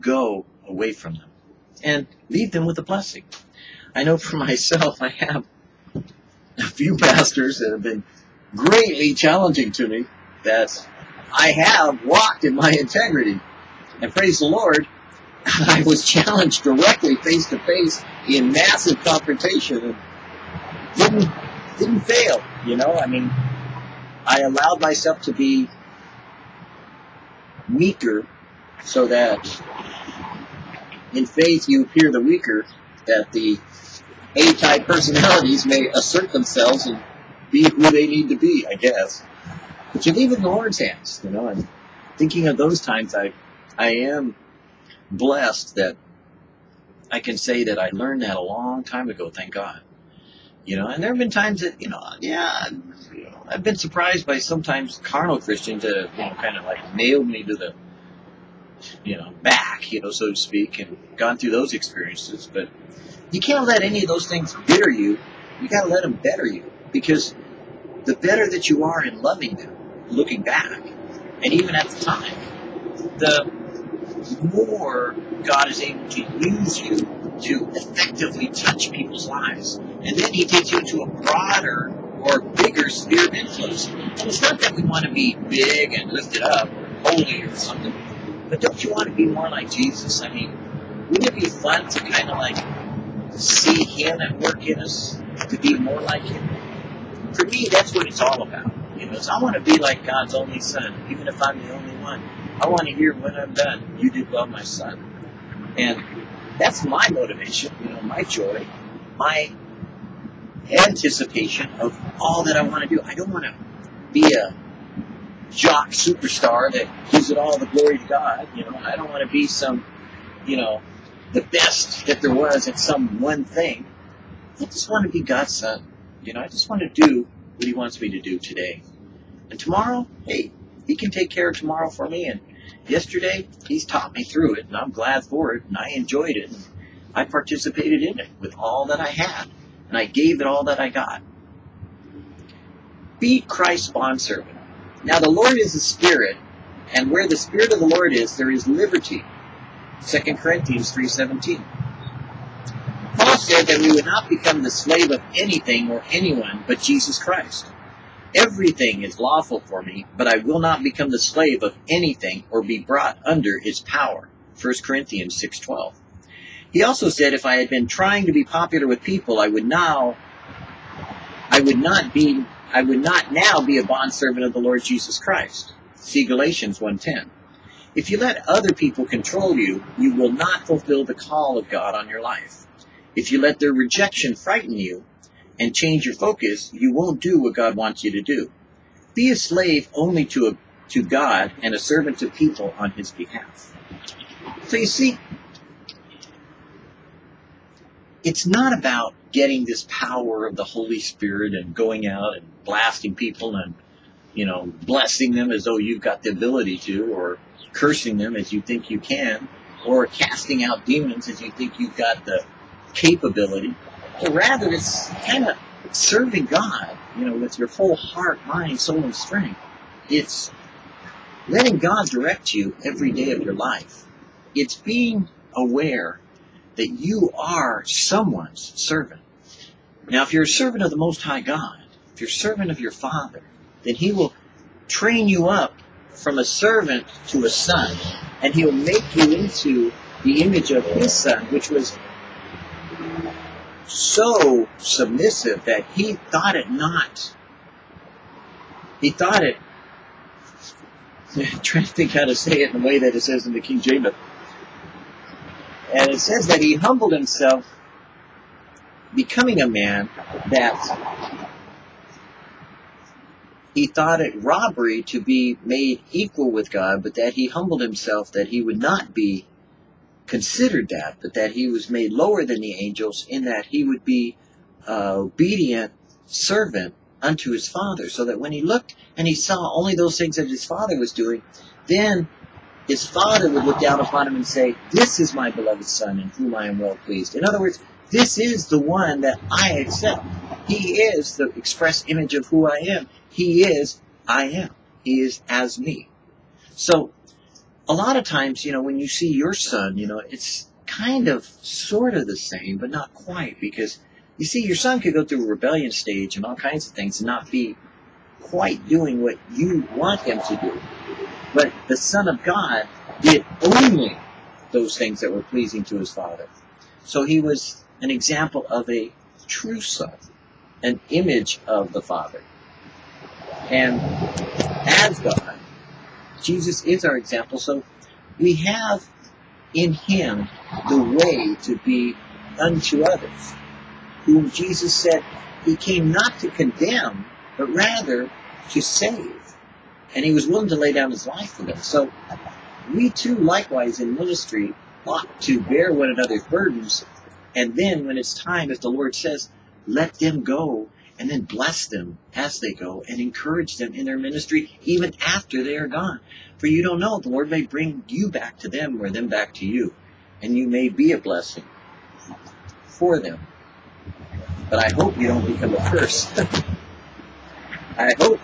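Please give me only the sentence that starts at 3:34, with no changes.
But rather, it's kind of serving God, you know, with your whole heart, mind, soul, and strength.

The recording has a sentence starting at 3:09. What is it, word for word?
Be a slave only to, a, to God and a servant to people on his behalf.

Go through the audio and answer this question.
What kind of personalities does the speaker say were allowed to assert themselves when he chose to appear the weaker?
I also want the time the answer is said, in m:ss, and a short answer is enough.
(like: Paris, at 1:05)
A-type, at 0:34.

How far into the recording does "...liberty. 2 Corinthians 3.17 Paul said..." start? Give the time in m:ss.
2:28.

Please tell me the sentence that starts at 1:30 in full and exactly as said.
I mean, wouldn't it be fun to kind of like see Him at work in us, to be more like Him?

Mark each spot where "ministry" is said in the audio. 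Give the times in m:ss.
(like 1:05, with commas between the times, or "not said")
5:44, 5:54.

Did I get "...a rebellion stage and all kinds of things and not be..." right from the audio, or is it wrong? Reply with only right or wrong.
right.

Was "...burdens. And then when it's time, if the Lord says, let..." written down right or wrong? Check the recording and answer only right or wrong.
right.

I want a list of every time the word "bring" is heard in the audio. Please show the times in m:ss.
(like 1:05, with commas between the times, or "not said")
5:57.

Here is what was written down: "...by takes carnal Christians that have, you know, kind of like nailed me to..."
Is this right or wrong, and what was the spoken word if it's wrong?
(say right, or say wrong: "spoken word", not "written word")
wrong: "sometimes", not "takes".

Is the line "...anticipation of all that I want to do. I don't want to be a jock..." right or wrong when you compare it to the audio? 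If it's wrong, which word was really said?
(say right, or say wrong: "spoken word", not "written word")
right.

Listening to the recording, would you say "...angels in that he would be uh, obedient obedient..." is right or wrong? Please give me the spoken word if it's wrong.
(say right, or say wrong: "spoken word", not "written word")
wrong: "servant", not "obedient".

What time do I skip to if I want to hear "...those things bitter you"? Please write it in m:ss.
1:04.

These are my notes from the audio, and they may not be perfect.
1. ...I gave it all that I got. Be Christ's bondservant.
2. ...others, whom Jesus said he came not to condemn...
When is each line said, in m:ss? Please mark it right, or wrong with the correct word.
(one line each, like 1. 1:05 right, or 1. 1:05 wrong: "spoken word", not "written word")
1. 2:19 right
2. 5:33 right.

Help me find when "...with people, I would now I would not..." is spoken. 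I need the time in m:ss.
2:48.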